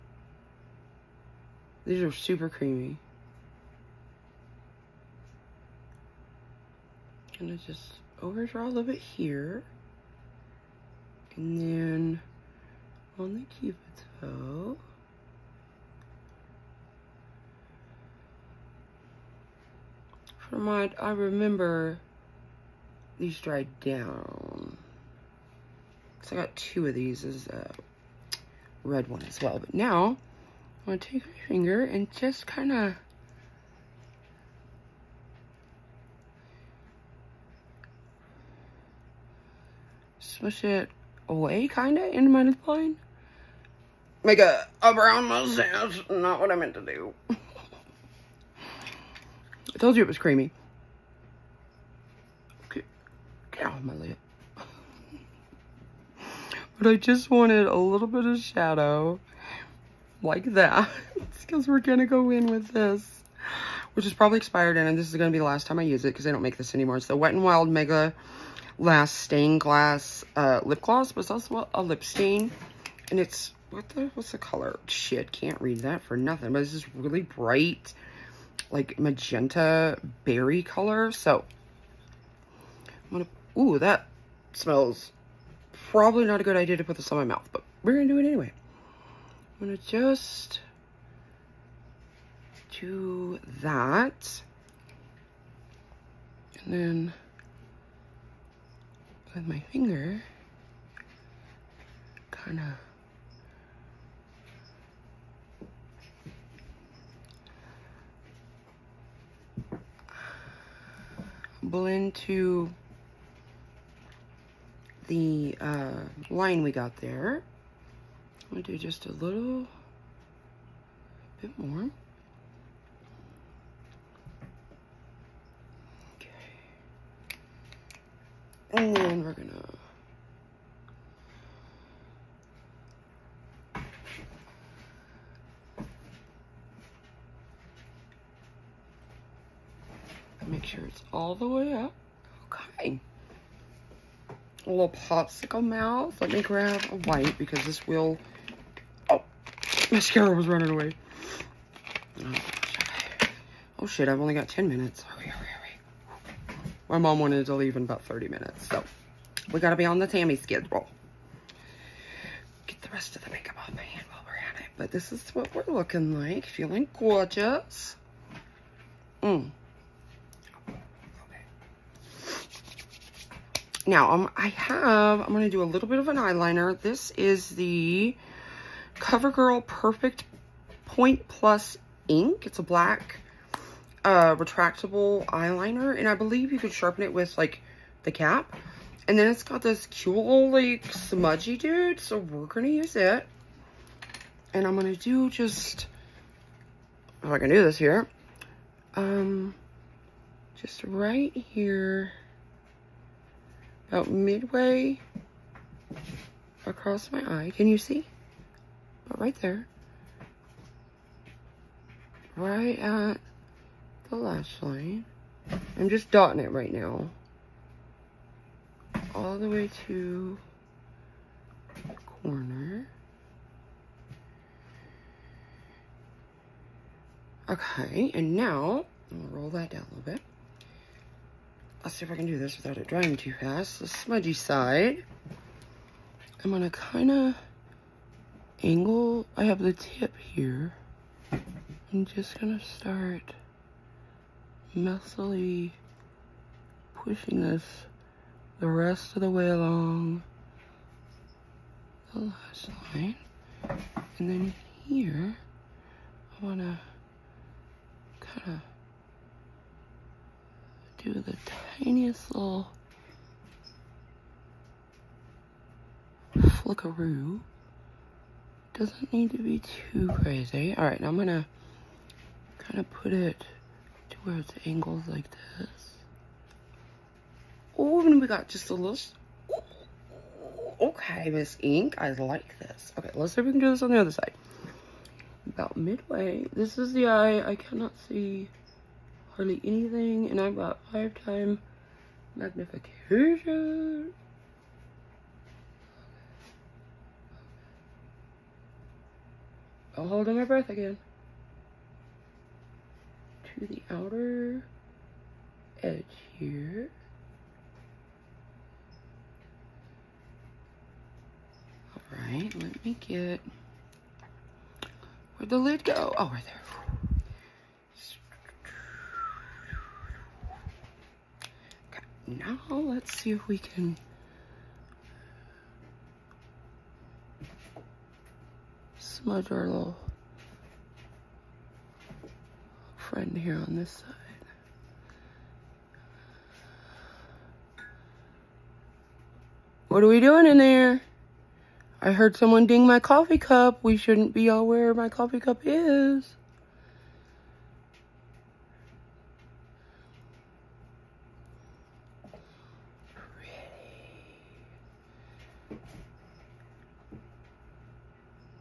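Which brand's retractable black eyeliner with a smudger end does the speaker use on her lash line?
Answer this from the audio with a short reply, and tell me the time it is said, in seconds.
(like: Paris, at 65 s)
CoverGirl, at 178 s.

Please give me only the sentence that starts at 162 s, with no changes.
Get the rest of the makeup off my hand while we're at it.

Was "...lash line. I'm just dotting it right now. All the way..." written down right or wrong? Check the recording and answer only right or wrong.
right.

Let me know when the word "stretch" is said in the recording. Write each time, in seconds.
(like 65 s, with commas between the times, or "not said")
not said.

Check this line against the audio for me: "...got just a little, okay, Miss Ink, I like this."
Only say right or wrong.
right.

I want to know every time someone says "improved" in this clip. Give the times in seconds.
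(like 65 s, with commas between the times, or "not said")
not said.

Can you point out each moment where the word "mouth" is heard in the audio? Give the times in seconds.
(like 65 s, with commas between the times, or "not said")
87 s, 145 s.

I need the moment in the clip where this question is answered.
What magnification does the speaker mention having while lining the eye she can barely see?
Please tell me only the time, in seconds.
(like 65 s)
290 s.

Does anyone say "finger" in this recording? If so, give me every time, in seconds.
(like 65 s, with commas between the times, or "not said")
31 s, 99 s.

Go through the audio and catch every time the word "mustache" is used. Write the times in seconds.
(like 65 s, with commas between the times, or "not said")
45 s.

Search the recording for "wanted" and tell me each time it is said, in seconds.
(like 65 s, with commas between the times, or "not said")
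57 s, 157 s.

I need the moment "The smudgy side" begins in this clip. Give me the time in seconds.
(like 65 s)
233 s.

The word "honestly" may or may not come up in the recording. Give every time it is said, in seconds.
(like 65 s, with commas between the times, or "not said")
not said.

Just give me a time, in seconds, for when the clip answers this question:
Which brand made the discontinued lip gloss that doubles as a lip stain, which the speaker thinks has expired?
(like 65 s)
67 s.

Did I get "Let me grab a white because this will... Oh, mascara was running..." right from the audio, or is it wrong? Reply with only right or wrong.
right.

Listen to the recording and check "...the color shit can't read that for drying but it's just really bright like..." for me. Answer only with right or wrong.
wrong.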